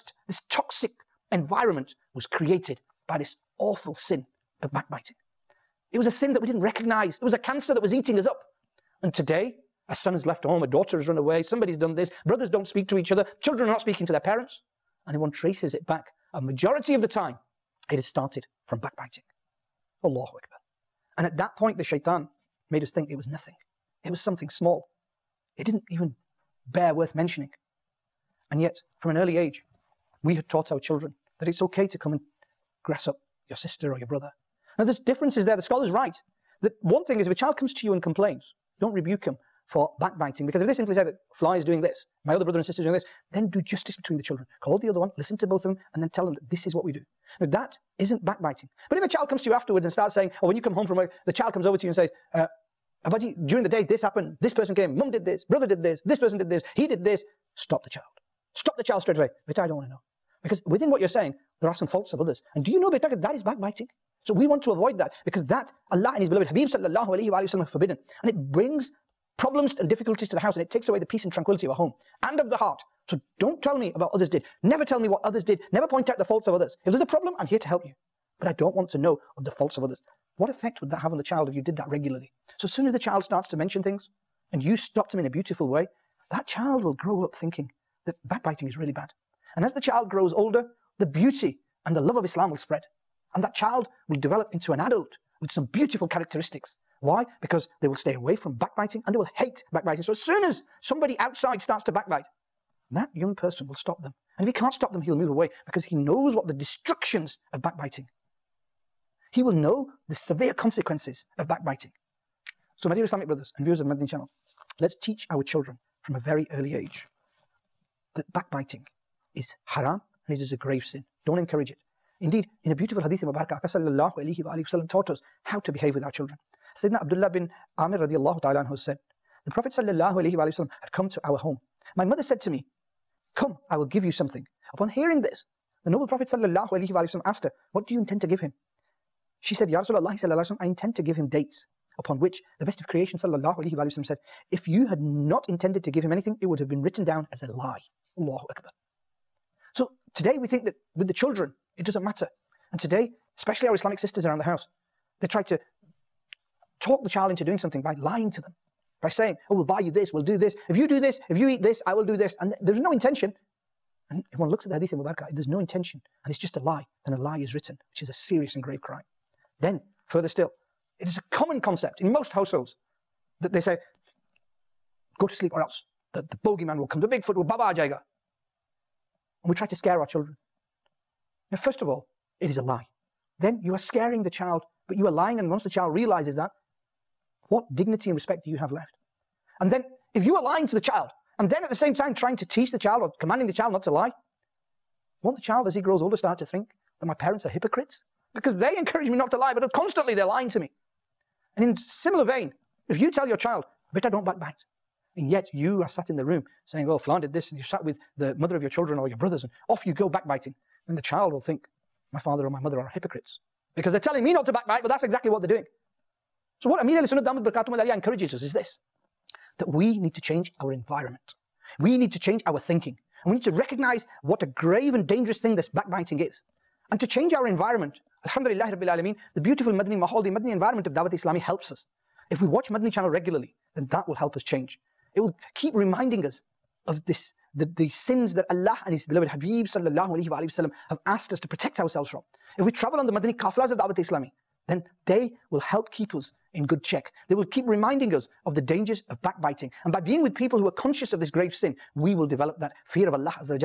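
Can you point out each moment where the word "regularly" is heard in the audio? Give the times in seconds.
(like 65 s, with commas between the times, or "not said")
81 s, 233 s.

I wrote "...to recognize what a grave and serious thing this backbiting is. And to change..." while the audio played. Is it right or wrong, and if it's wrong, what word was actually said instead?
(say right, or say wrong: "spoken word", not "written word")
wrong: "dangerous", not "serious".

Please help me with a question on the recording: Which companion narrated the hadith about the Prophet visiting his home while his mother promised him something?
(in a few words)
Abdullah bin Amir.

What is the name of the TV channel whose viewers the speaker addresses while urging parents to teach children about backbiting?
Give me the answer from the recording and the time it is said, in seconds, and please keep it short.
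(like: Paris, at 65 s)
Madni Channel, at 113 s.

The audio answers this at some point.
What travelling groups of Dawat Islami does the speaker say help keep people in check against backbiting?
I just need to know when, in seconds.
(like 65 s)
243 s.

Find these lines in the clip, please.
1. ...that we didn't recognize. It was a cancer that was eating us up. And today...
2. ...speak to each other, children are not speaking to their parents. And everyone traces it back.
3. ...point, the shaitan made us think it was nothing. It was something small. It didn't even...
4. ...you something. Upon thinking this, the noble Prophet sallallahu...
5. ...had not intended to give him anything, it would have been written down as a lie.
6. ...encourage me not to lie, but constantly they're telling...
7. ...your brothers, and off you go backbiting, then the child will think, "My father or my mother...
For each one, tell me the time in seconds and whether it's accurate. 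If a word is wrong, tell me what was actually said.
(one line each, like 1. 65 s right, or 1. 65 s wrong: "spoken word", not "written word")
1. 6 s right
2. 12 s right
3. 21 s right
4. 134 s wrong: "hearing", not "thinking"
5. 144 s right
6. 198 s wrong: "lying", not "telling"
7. 209 s right.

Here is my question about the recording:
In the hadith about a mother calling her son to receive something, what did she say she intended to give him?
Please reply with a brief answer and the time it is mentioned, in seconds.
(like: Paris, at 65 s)
Dates, at 141 s.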